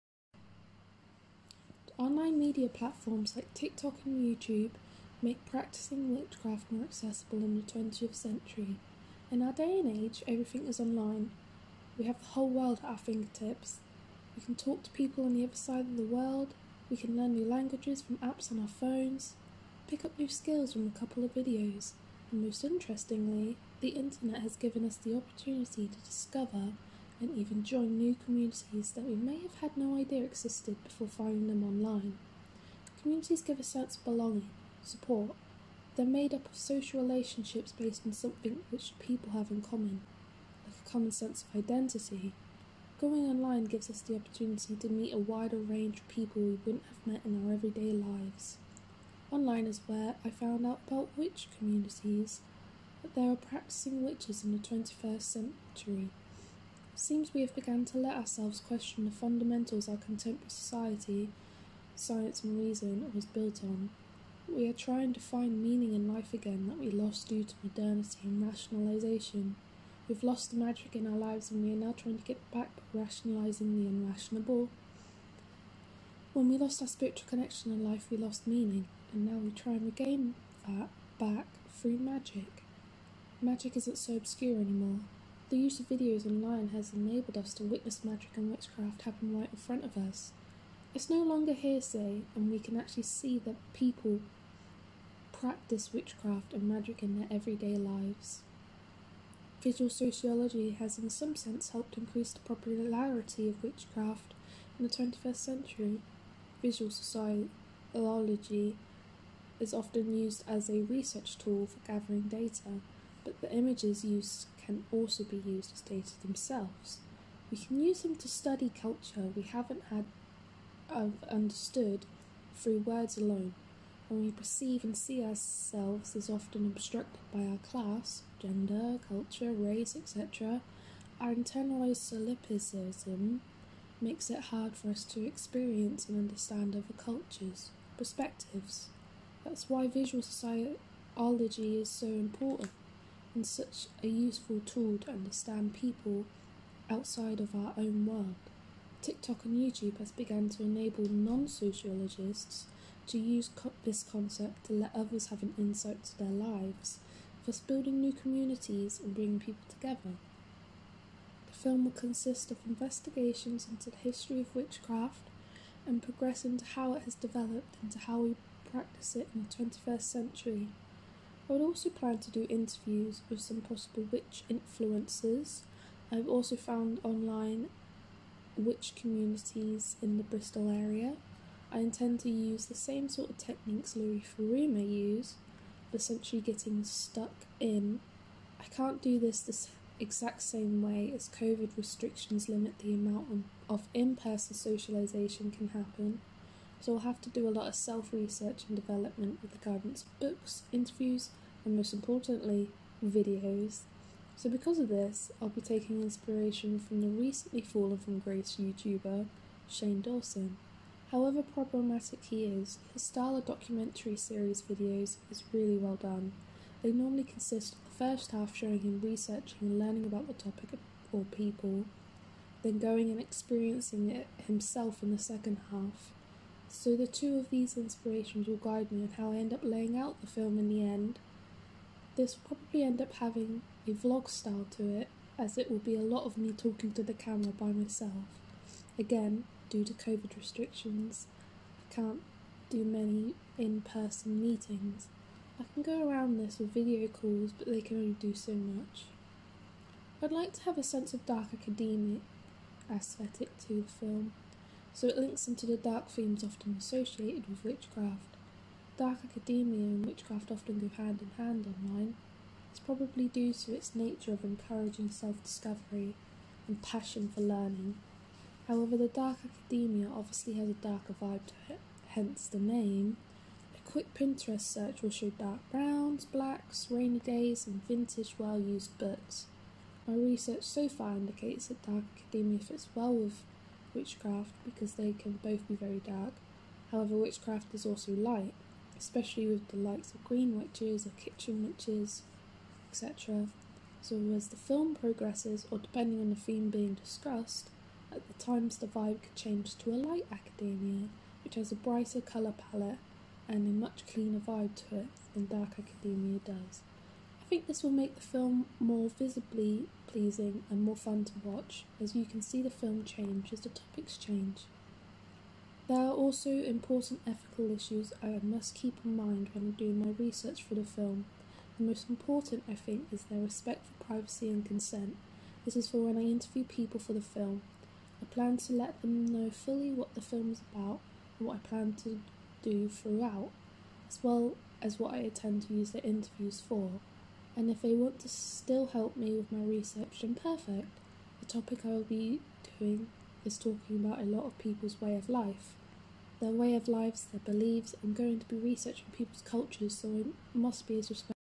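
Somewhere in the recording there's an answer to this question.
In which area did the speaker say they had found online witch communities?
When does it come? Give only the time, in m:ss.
3:00.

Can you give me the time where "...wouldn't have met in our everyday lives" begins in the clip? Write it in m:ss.
0:46.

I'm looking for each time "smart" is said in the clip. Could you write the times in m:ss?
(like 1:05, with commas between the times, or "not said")
not said.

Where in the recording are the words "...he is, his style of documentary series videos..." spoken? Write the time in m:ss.
3:32.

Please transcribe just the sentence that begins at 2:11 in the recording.
Our internalized solipsism makes it hard for us to experience and understand other cultures, perspectives.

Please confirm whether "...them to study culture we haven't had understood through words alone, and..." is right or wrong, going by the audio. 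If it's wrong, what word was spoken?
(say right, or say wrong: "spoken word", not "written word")
right.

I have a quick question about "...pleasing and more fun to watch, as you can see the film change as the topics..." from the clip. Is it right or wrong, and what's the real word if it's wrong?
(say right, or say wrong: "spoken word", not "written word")
right.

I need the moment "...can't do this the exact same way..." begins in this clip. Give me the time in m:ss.
3:08.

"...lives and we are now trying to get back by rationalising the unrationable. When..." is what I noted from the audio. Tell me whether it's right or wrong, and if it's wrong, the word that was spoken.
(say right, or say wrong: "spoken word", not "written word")
right.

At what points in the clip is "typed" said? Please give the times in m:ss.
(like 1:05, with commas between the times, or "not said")
not said.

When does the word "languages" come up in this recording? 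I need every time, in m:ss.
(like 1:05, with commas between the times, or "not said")
0:17.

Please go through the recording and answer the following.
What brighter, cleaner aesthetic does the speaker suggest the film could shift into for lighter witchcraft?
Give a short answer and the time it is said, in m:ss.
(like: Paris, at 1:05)
light academia, at 4:59.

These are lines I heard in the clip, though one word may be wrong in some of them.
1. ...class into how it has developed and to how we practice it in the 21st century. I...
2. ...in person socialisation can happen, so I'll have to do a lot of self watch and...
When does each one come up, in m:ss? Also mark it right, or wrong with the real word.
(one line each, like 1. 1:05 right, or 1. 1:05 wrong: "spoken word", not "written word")
1. 2:46 wrong: "progress", not "class"
2. 3:13 wrong: "research", not "watch".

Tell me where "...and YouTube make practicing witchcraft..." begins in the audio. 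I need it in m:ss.
0:04.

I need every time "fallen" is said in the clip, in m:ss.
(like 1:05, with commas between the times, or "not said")
3:27.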